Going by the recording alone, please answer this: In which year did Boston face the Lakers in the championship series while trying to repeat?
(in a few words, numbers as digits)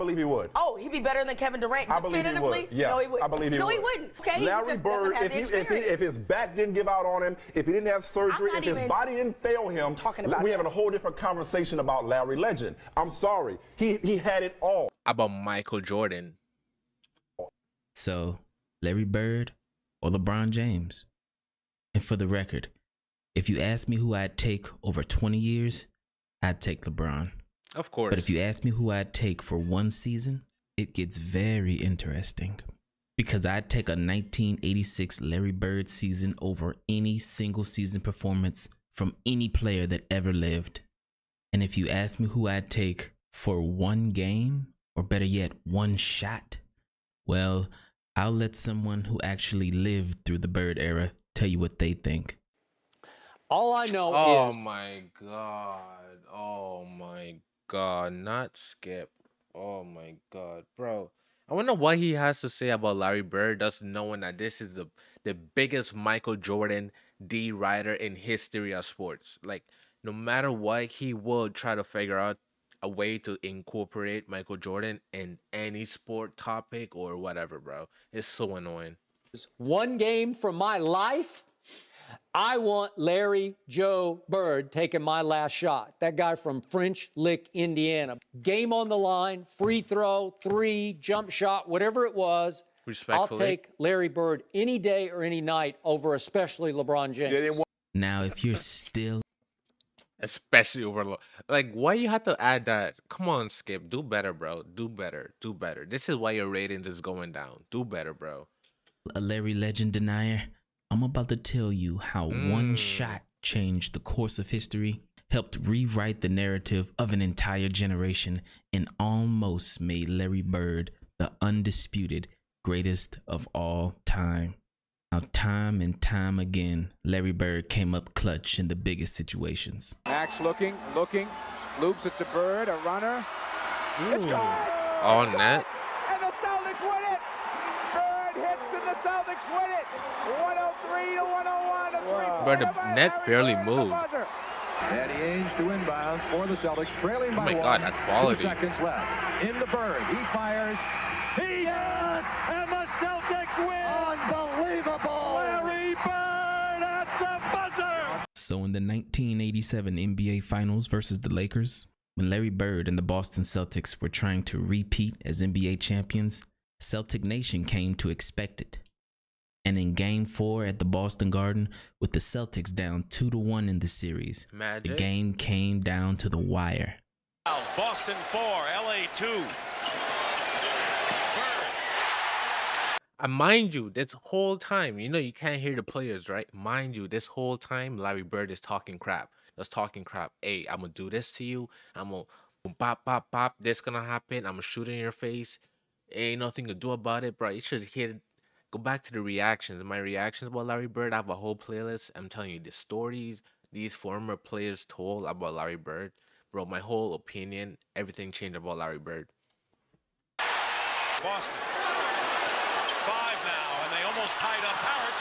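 1987.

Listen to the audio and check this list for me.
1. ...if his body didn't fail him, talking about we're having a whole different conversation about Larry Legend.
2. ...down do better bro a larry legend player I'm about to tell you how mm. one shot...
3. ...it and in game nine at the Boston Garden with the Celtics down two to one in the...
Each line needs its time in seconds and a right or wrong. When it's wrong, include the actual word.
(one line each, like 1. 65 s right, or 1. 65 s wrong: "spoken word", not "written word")
1. 8 s right
2. 107 s wrong: "denier", not "player"
3. 168 s wrong: "four", not "nine".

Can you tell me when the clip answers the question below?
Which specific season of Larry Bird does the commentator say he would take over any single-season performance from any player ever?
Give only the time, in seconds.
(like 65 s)
33 s.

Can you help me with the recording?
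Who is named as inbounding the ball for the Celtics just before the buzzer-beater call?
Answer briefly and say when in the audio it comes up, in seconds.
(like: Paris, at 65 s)
Eddie Ainge, at 144 s.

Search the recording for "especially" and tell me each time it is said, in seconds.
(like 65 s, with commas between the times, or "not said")
96 s, 100 s.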